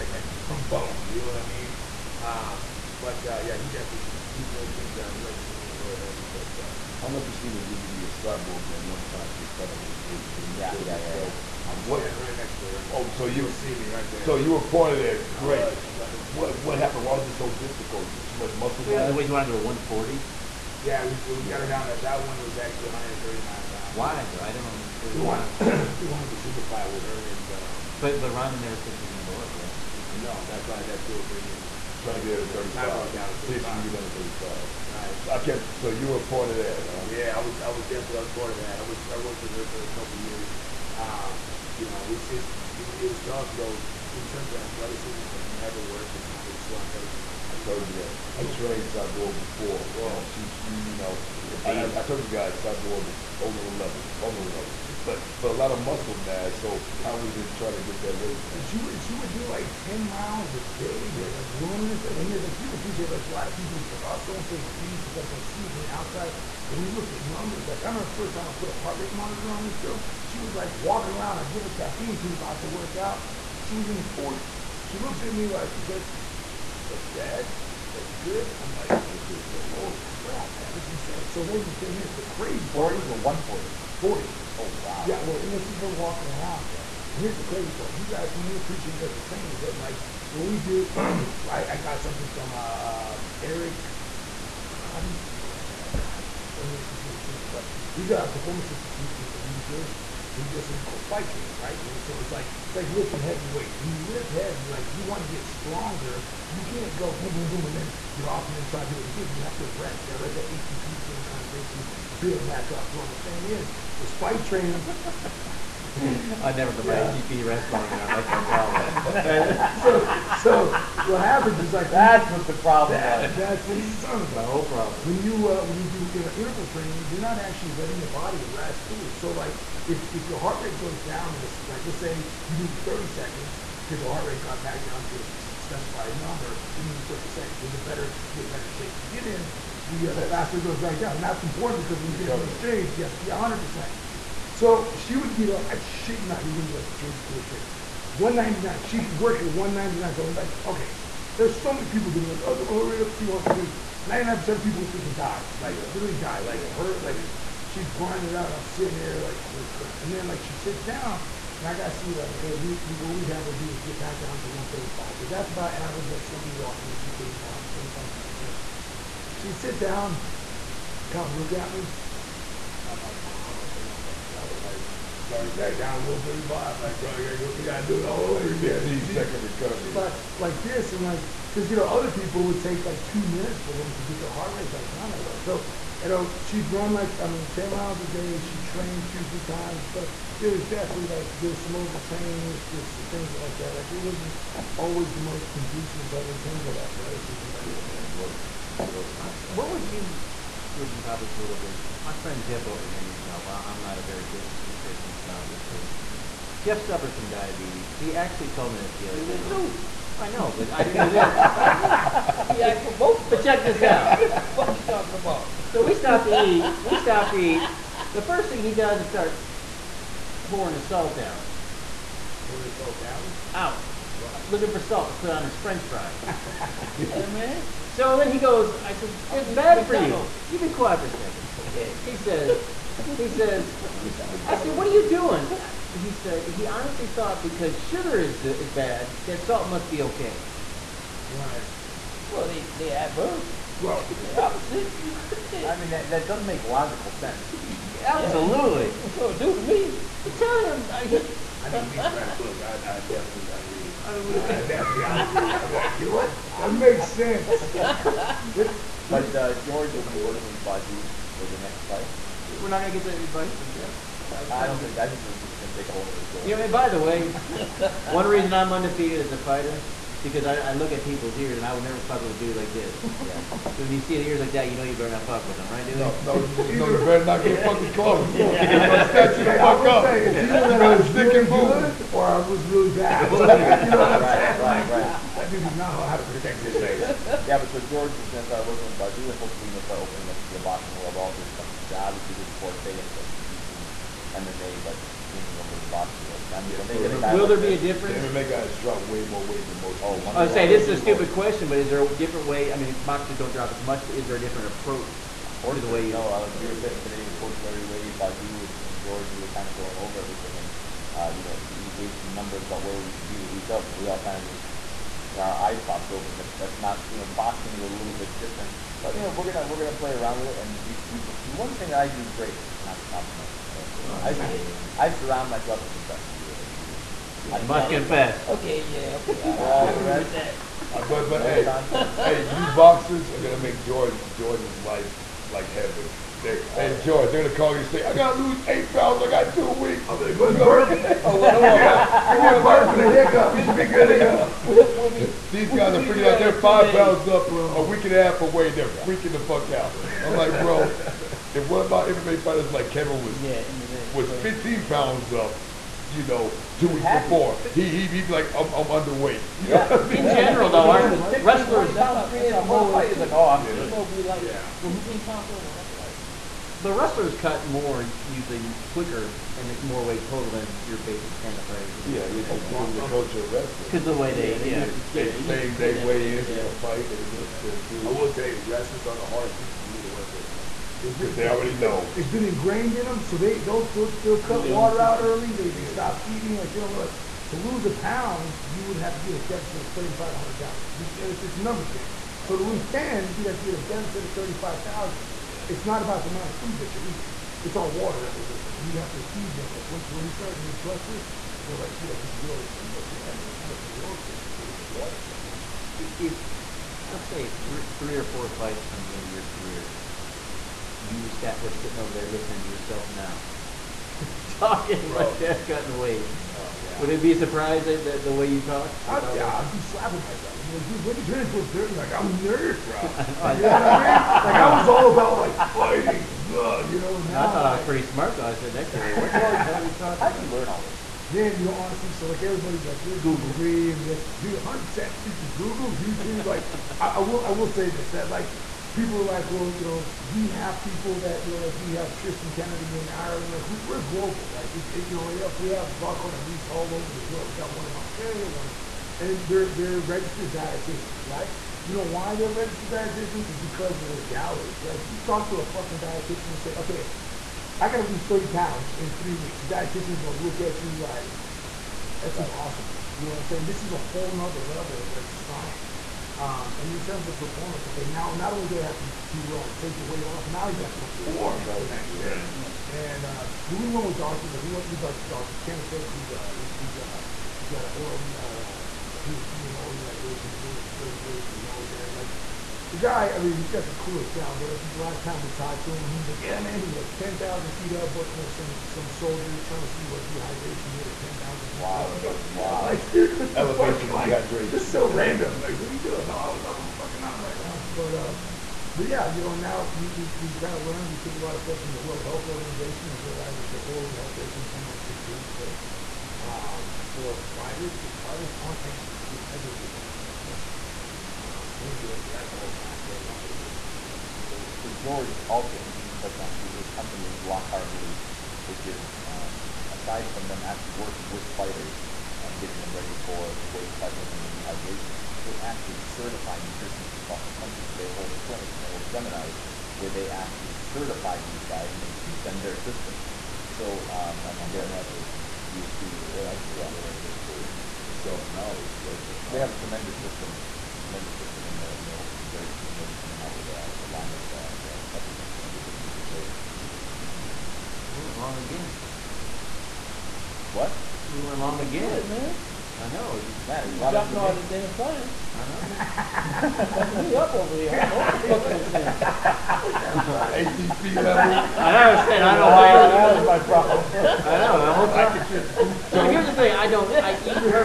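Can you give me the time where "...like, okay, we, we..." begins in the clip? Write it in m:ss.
2:42.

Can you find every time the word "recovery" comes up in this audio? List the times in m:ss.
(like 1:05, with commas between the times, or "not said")
2:22, 2:59.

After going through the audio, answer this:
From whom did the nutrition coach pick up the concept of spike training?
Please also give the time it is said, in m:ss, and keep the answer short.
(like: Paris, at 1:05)
Eric DeGrati, at 1:33.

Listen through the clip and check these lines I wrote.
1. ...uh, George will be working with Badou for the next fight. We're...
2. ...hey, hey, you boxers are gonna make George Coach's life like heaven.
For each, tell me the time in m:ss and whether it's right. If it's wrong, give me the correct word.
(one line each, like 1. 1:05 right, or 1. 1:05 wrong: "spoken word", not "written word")
1. 4:19 right
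2. 5:31 wrong: "George", not "Coach".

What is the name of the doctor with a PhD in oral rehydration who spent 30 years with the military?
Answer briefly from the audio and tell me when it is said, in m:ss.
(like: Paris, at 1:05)
Dr. Kenefick, at 7:55.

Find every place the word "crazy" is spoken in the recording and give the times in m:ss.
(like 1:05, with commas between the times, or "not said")
1:22, 1:27, 5:54.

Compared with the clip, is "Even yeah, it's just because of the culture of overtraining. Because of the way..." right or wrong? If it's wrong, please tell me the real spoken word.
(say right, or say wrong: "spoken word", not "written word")
wrong: "wrestling", not "overtraining".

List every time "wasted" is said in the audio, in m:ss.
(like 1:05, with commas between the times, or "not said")
not said.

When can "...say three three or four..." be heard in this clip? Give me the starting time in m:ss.
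6:47.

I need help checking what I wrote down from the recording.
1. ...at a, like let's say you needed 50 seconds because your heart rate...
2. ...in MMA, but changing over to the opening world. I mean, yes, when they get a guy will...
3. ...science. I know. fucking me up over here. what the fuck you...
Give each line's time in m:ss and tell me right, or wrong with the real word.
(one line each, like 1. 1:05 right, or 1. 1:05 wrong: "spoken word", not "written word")
1. 2:11 wrong: "30", not "50"
2. 4:53 wrong: "boxing", not "opening"
3. 9:14 right.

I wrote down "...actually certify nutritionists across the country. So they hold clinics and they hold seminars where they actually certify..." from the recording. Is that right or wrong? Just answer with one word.
right.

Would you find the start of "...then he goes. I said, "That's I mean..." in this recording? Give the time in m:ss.
3:48.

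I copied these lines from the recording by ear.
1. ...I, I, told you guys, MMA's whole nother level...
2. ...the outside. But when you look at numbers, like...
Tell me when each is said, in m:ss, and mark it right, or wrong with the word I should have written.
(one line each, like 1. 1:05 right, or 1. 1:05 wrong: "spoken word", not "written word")
1. 0:51 wrong: "Cyborg", not "MMA"
2. 1:05 right.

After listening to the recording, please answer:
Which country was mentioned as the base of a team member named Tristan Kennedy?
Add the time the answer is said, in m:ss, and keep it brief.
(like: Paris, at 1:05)
Ireland, at 7:23.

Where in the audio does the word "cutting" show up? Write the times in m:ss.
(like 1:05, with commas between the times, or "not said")
6:55.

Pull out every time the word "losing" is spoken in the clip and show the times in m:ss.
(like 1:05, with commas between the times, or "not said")
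6:38.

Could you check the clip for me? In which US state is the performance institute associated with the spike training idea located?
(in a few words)
New Jersey.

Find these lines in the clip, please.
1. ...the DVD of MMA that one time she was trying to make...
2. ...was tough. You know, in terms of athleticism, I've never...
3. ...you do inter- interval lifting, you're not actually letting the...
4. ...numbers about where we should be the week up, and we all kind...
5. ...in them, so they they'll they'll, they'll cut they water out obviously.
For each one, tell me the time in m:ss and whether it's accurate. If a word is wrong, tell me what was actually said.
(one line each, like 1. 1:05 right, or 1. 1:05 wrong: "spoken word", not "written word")
1. 0:07 wrong: "Cyborg", not "MMA"
2. 0:43 right
3. 2:05 wrong: "training", not "lifting"
4. 5:12 right
5. 6:22 wrong: "early", not "obviously".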